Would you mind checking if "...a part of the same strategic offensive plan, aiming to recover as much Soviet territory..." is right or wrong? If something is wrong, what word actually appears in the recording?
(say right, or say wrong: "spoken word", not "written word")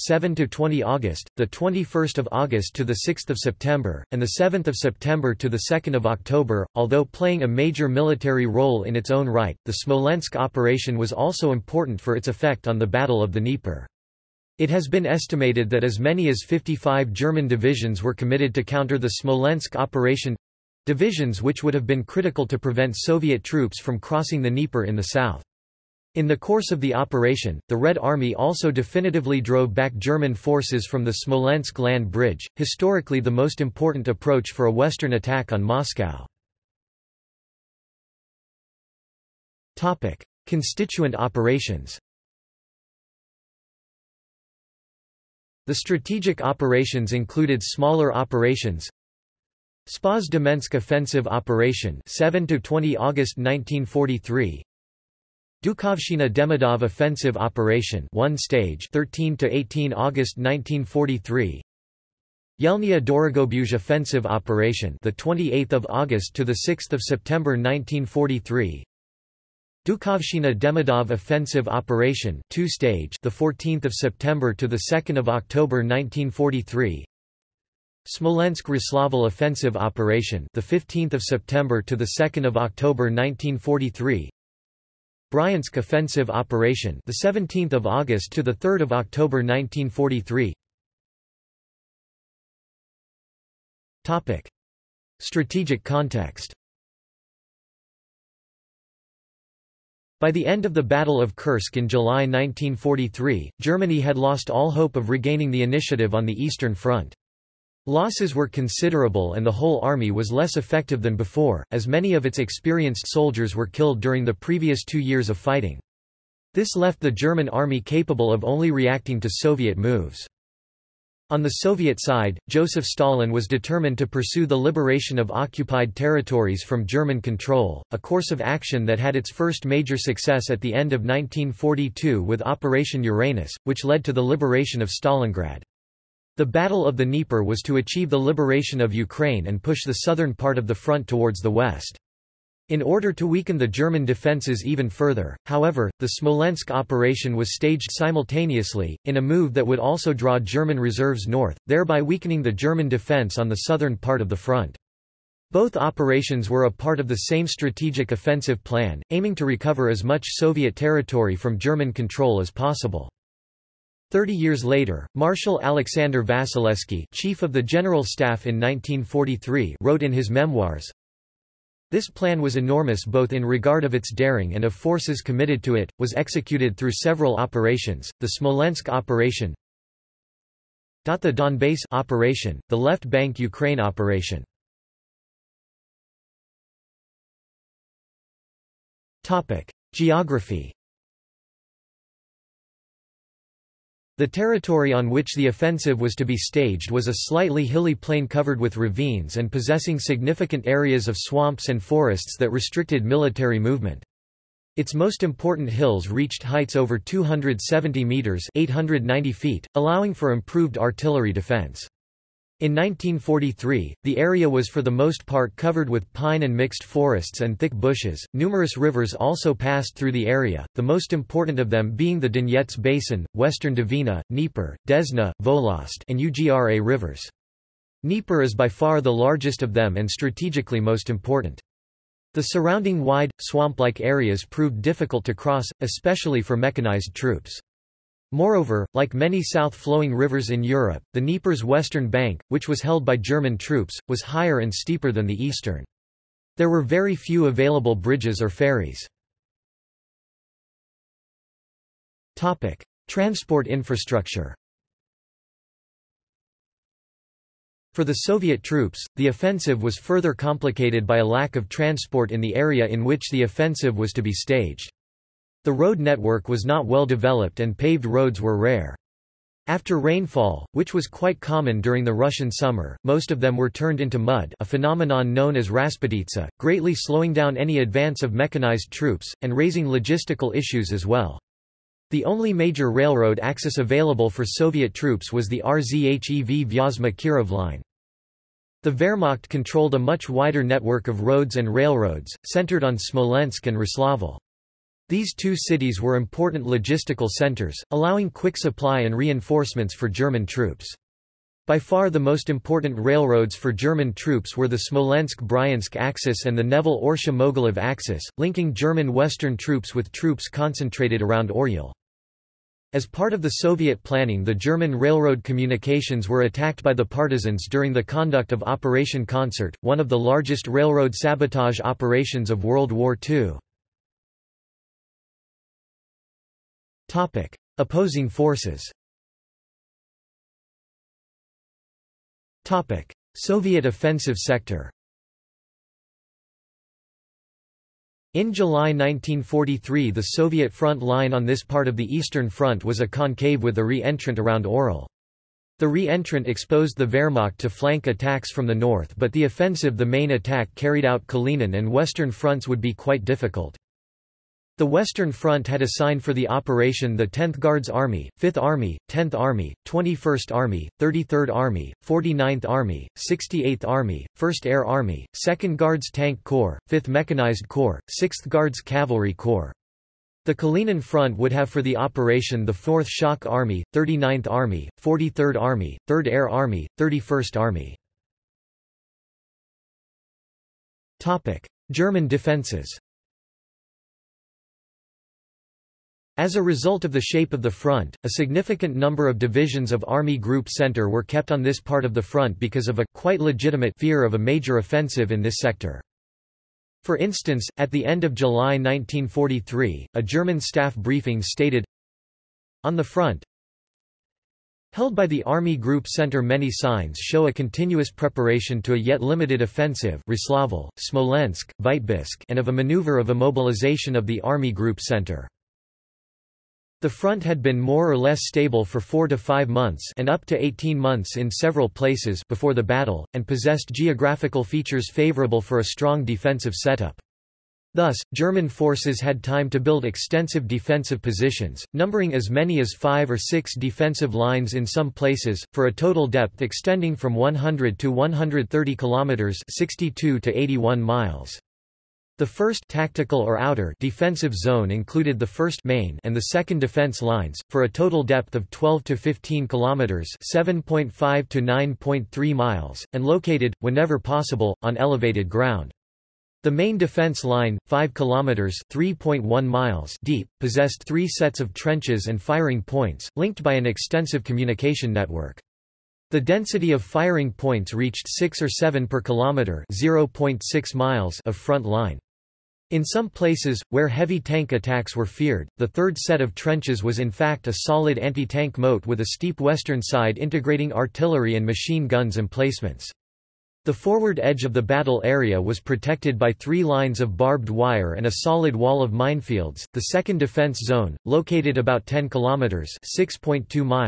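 right.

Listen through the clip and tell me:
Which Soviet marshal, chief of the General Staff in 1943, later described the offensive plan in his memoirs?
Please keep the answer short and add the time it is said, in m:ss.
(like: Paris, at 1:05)
Alexander Vasilevsky, at 2:45.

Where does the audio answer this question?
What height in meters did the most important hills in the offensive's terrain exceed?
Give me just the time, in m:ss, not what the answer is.
3:26.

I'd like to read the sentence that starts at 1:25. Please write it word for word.
Bryansk offensive operation, the 17th of August to the 3rd of October 1943.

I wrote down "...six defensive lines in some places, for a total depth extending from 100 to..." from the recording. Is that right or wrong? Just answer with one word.
right.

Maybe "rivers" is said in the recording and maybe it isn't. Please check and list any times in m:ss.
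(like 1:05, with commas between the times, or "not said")
3:38, 3:46, 4:00.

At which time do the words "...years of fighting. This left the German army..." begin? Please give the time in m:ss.
1:54.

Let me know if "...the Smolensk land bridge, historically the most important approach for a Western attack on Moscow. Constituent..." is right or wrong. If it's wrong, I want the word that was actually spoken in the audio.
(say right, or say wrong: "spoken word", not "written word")
right.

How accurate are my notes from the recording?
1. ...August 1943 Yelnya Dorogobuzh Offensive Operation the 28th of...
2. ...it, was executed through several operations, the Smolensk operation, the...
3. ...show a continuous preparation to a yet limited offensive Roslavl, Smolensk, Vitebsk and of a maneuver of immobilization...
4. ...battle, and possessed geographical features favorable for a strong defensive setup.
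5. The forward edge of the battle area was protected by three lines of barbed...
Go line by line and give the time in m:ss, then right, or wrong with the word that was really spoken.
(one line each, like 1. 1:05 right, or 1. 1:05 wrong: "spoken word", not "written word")
1. 0:59 right
2. 2:55 right
3. 6:47 right
4. 7:02 right
5. 8:03 right.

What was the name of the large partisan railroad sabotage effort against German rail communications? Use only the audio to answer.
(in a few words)
Operation Concert.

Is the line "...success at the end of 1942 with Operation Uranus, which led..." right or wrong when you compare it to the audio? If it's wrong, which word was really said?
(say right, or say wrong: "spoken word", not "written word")
right.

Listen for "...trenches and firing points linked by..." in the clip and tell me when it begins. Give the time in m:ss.
7:41.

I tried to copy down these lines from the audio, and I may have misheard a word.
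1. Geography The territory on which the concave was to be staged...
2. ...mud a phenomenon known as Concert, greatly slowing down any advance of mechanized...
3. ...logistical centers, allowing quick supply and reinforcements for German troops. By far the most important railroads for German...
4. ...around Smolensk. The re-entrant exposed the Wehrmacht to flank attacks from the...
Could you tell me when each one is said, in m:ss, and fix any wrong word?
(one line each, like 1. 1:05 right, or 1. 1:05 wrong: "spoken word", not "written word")
1. 3:09 wrong: "offensive", not "concave"
2. 4:34 wrong: "Rasputitsa", not "Concert"
3. 4:56 right
4. 5:44 wrong: "Oryol", not "Smolensk".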